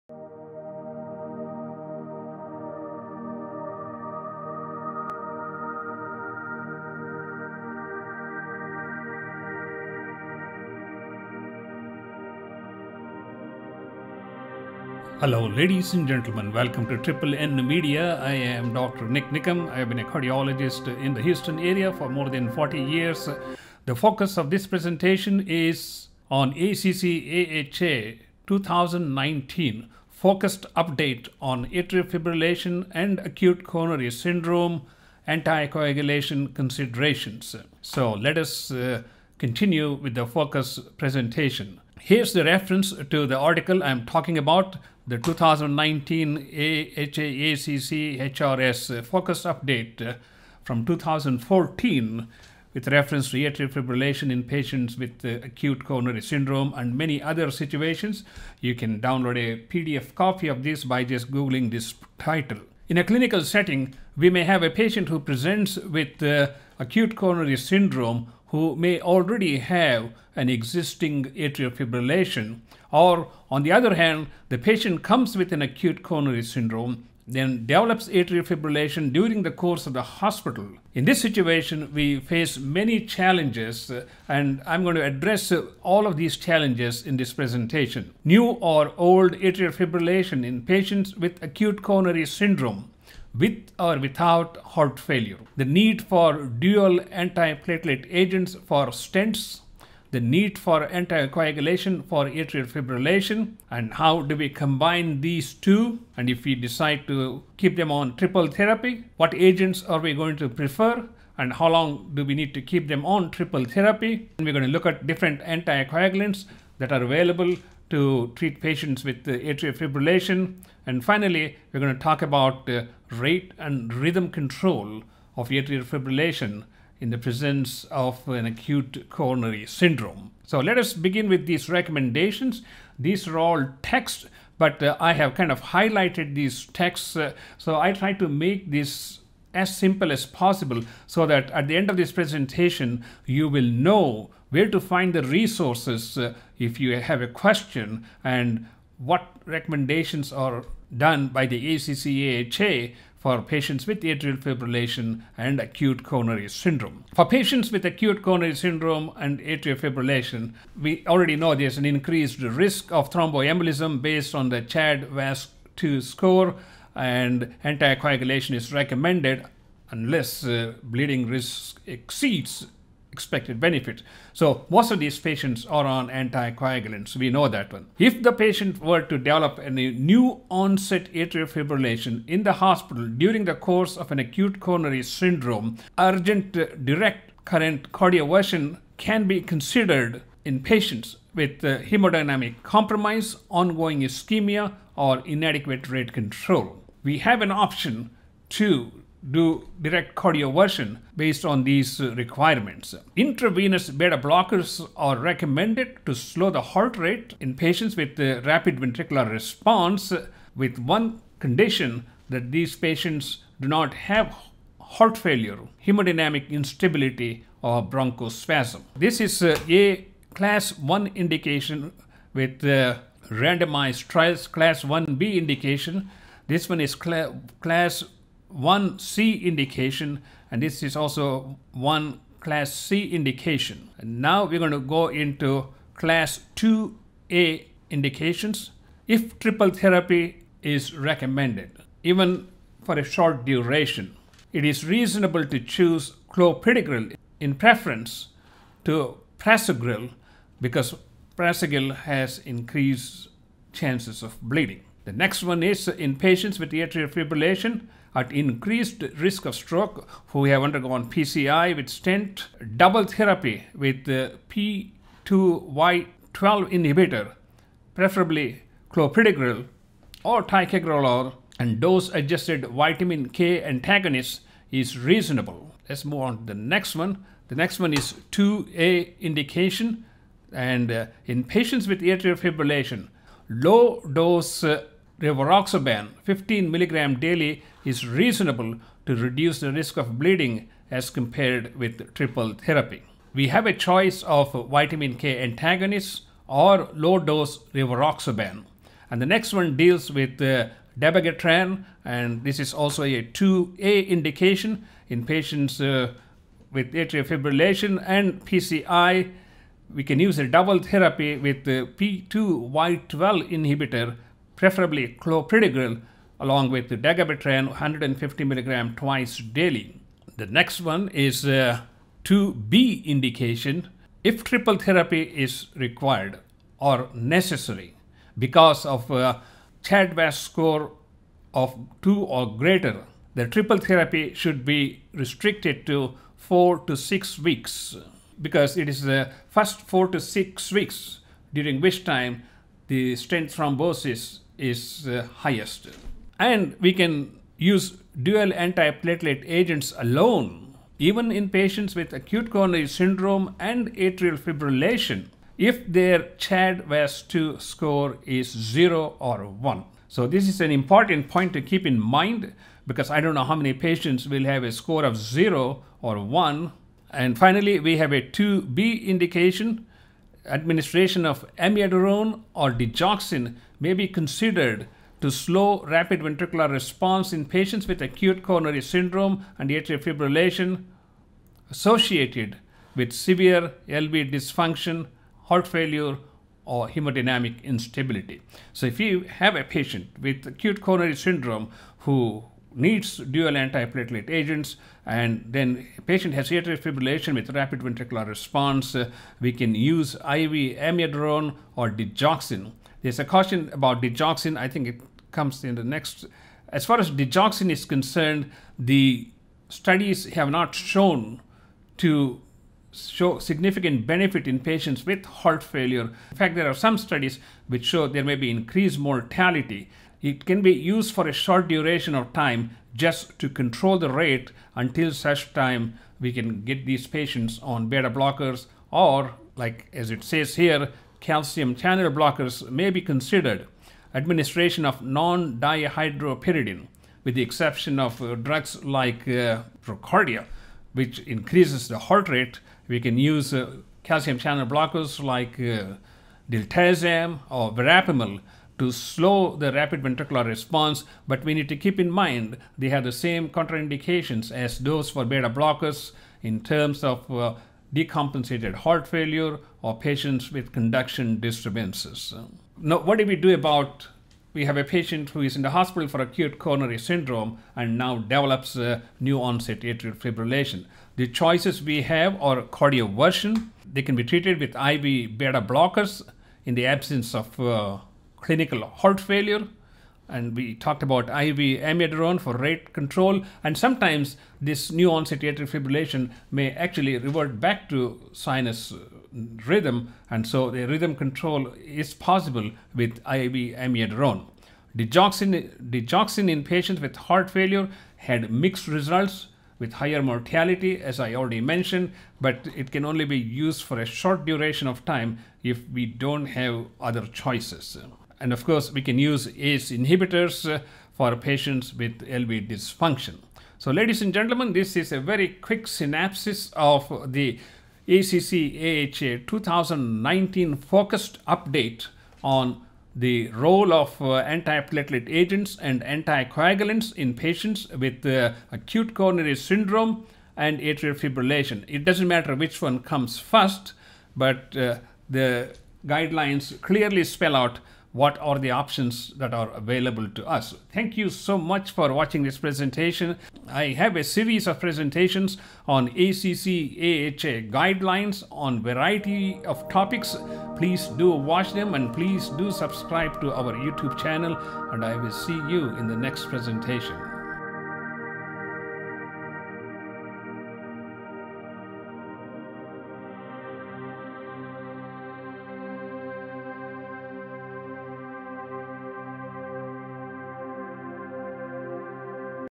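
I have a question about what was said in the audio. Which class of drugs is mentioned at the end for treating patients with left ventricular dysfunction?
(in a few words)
ACE inhibitors.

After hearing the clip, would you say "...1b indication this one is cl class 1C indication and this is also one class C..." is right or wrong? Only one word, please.
right.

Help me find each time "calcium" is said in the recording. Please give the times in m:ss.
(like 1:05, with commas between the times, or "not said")
7:11, 7:24.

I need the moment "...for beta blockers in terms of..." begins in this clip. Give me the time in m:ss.
7:35.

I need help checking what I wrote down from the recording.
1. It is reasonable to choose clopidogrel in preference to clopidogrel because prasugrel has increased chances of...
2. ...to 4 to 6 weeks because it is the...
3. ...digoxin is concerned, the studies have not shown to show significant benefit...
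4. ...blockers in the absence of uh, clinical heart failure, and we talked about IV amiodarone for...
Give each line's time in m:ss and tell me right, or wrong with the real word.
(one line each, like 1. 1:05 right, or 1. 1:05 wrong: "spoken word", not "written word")
1. 4:04 wrong: "prasugrel", not "clopidogrel"
2. 5:35 right
3. 6:47 right
4. 7:55 right.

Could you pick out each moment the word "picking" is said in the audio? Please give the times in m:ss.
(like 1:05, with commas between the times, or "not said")
not said.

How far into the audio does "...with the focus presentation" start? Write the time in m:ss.
0:39.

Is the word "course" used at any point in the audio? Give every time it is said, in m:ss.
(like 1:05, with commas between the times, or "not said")
1:19, 3:03, 8:28.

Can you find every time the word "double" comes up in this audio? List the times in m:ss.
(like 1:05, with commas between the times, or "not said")
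4:22, 5:10.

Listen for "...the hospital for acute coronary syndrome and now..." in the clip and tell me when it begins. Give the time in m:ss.
7:45.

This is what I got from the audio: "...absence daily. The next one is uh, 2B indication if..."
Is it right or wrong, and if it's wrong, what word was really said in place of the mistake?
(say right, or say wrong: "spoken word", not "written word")
wrong: "twice", not "absence".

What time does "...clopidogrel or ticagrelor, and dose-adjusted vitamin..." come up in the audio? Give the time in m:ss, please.
4:28.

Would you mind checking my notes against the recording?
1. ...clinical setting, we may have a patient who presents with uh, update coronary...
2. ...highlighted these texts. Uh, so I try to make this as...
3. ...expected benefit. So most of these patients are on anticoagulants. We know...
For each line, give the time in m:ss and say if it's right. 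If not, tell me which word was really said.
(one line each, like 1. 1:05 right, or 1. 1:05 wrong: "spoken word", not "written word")
1. 1:03 wrong: "acute", not "update"
2. 2:15 right
3. 2:53 right.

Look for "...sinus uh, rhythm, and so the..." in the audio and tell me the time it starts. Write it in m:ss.
8:08.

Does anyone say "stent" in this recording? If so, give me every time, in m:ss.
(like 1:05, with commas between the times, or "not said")
1:38, 4:21, 5:43.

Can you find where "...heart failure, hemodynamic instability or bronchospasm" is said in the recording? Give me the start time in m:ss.
3:34.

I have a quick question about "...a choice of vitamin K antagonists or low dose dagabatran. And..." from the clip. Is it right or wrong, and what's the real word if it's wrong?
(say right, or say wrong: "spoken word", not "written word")
wrong: "rivaroxaban", not "dagabatran".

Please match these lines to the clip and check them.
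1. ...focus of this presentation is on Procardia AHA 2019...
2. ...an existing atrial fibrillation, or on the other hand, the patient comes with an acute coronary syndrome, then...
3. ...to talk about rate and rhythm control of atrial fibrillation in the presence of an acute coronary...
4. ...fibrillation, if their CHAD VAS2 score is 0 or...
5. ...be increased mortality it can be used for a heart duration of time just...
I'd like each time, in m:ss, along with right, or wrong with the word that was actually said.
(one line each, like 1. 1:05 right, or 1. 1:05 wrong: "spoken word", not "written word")
1. 0:23 wrong: "ACC", not "Procardia"
2. 1:10 right
3. 2:01 right
4. 5:54 right
5. 6:58 wrong: "short", not "heart".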